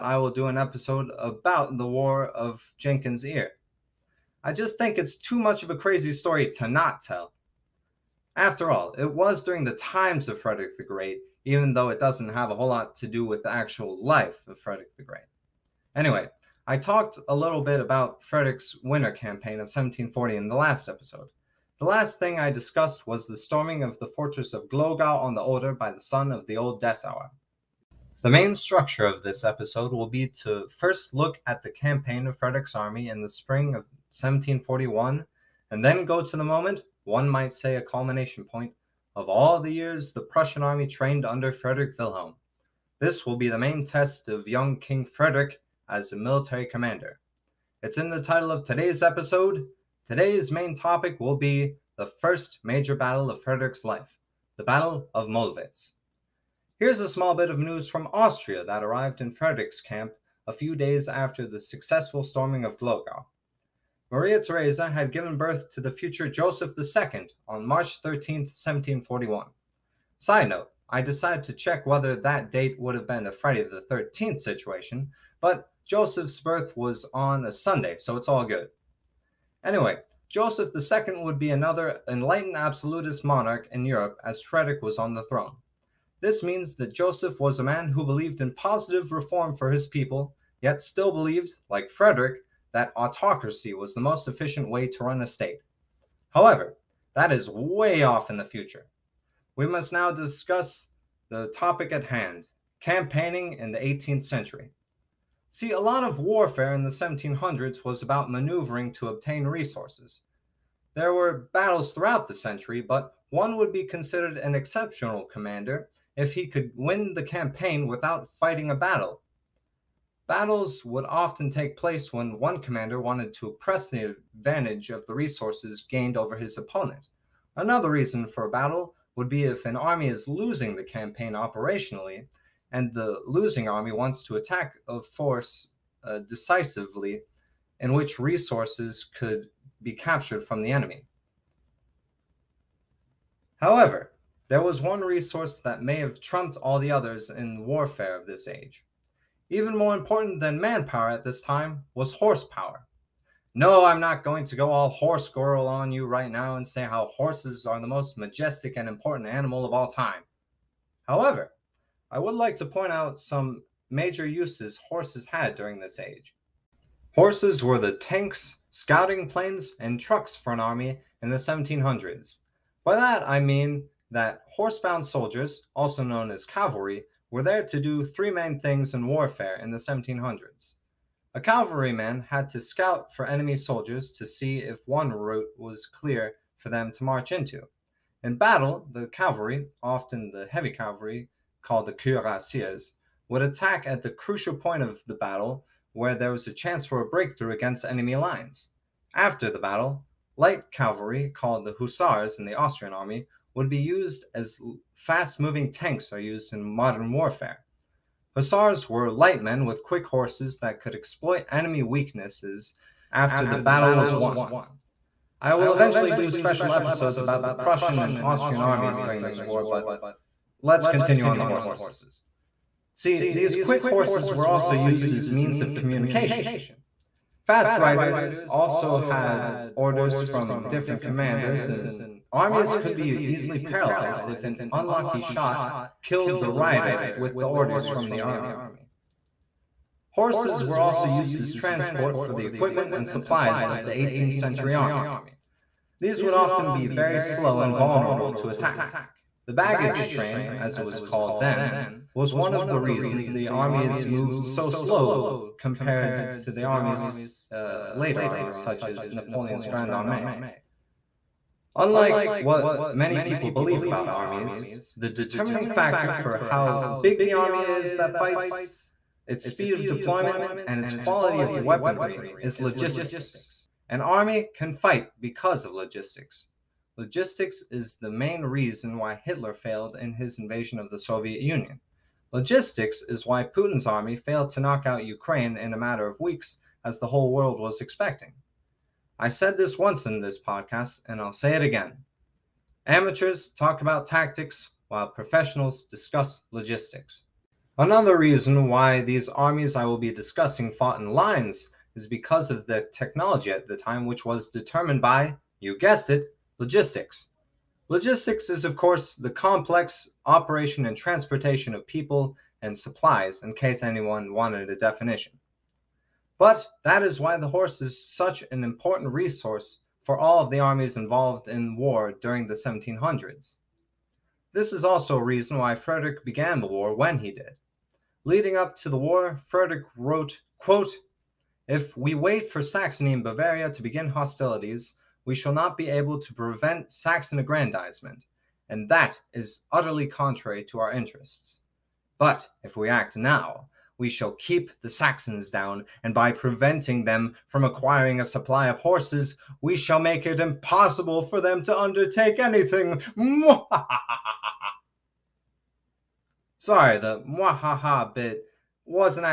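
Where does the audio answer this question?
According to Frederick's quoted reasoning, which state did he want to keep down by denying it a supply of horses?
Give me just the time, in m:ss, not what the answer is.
5:44.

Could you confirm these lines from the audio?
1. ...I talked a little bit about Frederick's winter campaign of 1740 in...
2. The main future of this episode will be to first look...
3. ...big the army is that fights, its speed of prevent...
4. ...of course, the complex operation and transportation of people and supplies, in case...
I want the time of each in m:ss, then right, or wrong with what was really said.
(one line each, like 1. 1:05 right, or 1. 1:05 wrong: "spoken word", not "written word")
1. 0:16 right
2. 0:28 wrong: "structure", not "future"
3. 4:27 wrong: "deployment", not "prevent"
4. 5:08 right.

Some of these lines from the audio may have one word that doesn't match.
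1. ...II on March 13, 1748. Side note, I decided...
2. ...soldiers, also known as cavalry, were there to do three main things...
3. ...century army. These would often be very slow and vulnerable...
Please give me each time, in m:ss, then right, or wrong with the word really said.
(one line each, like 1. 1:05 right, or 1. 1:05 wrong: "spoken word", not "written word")
1. 1:06 wrong: "1741", not "1748"
2. 2:55 right
3. 4:04 right.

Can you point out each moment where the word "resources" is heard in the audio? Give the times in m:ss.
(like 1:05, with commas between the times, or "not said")
1:49, 2:05, 2:18, 2:25, 5:19.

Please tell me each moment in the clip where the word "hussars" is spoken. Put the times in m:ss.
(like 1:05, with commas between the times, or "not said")
3:21, 3:28.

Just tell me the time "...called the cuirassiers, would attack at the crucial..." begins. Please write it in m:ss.
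3:11.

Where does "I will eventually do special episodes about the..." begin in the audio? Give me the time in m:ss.
3:35.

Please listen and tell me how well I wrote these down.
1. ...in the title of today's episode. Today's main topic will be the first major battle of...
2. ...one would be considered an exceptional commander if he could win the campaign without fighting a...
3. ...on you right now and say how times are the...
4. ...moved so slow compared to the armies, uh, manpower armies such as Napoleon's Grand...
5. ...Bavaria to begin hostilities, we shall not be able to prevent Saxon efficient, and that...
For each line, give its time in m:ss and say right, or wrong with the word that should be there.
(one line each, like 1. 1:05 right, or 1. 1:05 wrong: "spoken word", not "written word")
1. 0:47 right
2. 1:53 right
3. 2:35 wrong: "horses", not "times"
4. 4:14 wrong: "later", not "manpower"
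5. 5:33 wrong: "aggrandizement", not "efficient".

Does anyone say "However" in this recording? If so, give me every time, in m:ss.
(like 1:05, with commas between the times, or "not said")
1:36, 2:23, 2:41.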